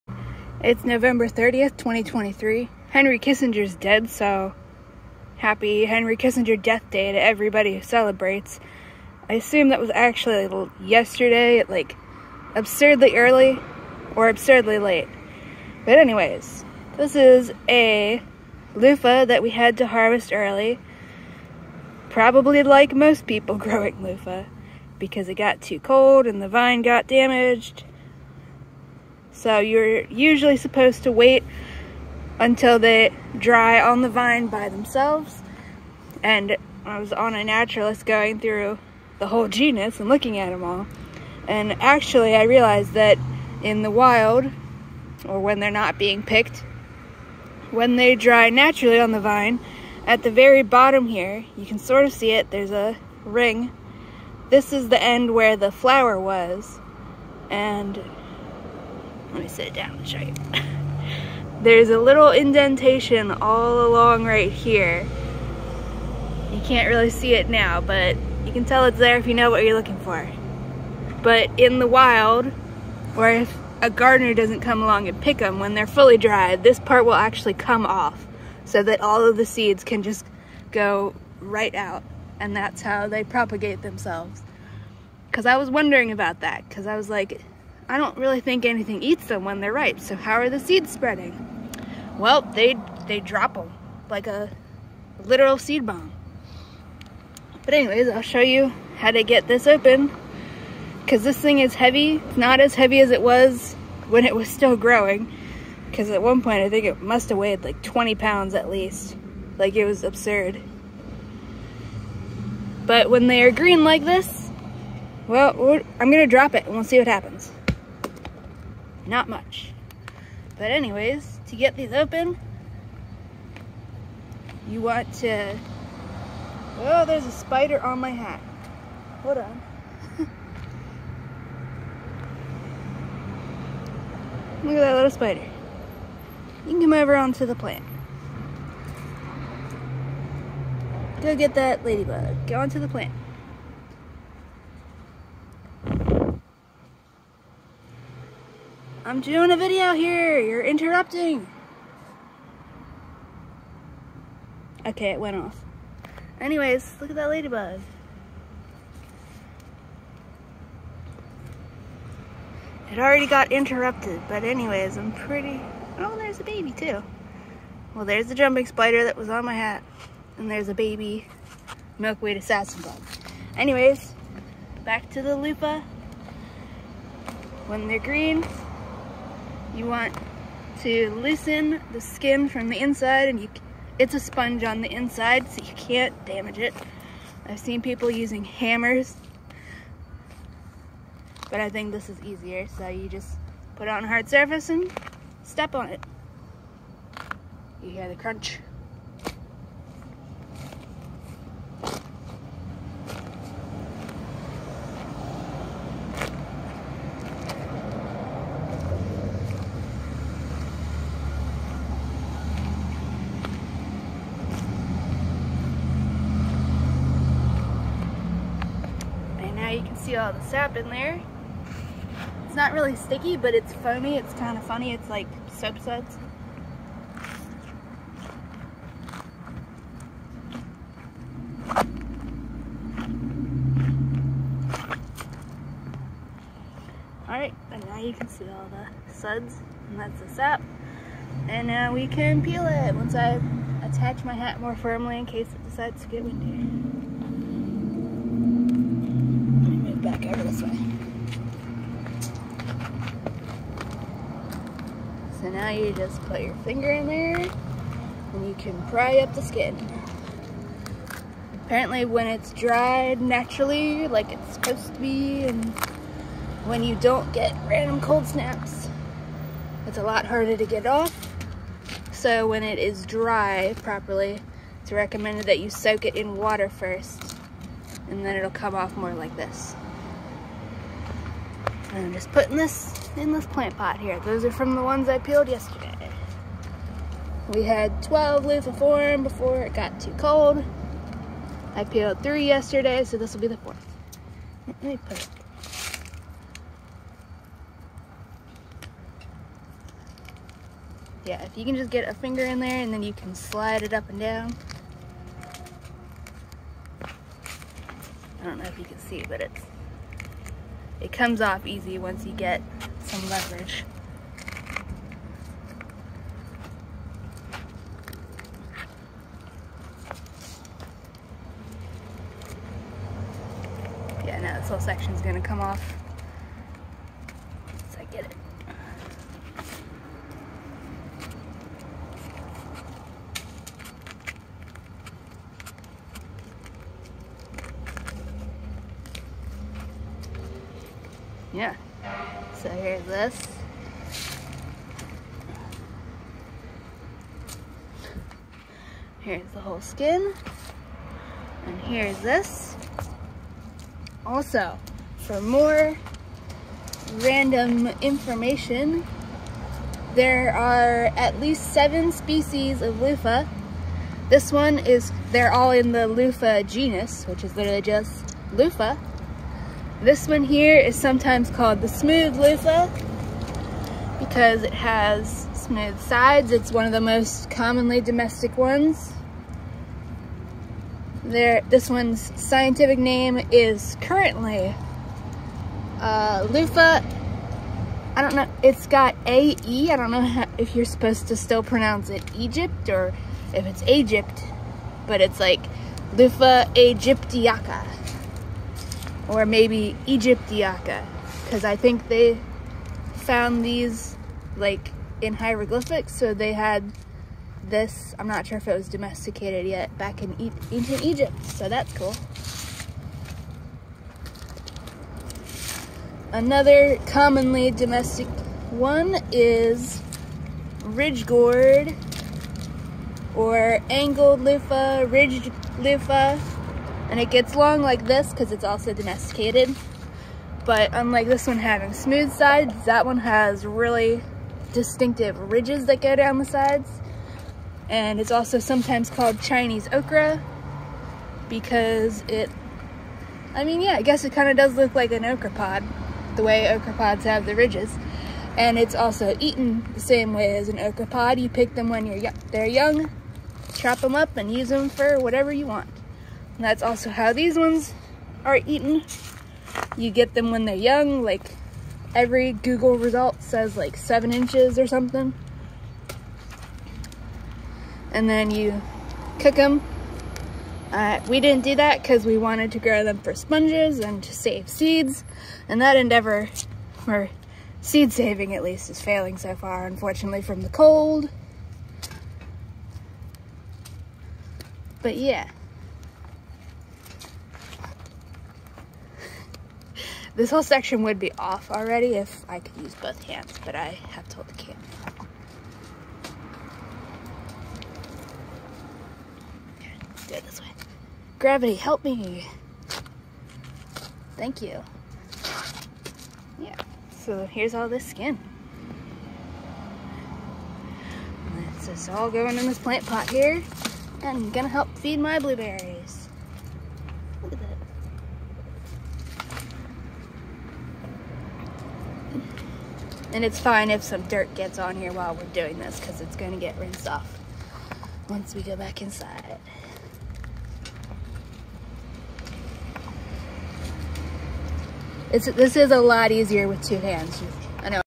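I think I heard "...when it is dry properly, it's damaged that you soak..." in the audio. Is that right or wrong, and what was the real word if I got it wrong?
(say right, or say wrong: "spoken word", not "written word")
wrong: "recommended", not "damaged".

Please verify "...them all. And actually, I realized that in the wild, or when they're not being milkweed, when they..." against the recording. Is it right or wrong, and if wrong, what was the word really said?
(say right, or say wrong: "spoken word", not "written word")
wrong: "picked", not "milkweed".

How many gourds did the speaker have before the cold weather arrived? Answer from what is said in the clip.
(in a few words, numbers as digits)
12.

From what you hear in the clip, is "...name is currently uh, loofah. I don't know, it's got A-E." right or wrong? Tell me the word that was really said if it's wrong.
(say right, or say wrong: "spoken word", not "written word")
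right.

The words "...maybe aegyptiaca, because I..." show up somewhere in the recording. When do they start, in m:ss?
6:39.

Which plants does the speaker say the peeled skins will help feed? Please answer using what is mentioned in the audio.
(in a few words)
blueberries.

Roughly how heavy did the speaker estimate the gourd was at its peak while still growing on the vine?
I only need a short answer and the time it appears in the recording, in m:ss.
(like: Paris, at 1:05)
20 pounds, at 1:47.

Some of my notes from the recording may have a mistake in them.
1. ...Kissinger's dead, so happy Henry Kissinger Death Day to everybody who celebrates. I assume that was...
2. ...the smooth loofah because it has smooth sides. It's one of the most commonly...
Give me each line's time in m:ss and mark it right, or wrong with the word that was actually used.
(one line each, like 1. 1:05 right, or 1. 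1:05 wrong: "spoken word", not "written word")
1. 0:03 right
2. 6:11 right.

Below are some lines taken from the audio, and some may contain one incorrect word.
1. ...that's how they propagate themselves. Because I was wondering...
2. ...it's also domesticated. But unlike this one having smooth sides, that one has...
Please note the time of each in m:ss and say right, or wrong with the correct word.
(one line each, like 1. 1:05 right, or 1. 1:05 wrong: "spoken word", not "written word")
1. 1:22 right
2. 7:08 right.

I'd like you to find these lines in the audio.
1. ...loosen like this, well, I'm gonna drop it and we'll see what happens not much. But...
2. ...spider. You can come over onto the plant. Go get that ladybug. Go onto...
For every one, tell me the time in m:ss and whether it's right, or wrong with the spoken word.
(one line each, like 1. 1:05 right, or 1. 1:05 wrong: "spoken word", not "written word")
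1. 1:53 wrong: "green", not "loosen"
2. 2:15 right.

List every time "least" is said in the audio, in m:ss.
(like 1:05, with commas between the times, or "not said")
1:48, 6:01, 7:58.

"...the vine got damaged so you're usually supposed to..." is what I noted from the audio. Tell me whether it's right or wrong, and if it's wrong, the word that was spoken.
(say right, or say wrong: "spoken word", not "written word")
right.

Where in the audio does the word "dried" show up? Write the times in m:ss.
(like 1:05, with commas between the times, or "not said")
1:16, 4:22.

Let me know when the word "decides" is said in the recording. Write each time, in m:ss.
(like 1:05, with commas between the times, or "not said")
4:05.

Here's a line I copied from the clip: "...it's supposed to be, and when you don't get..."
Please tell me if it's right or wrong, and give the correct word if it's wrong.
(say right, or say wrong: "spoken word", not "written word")
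right.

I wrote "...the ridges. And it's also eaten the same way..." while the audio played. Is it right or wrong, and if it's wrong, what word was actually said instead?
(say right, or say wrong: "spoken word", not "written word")
right.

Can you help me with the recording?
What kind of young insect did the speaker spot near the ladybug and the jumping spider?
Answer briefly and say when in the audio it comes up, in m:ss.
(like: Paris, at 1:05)
milkweed assassin bug, at 2:51.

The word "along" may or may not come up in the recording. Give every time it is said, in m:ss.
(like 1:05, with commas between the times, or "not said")
1:03, 1:14.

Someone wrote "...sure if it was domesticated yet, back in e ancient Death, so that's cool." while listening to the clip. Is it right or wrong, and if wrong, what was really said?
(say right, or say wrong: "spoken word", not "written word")
wrong: "Egypt", not "Death".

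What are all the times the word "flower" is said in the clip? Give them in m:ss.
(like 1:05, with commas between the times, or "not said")
0:55.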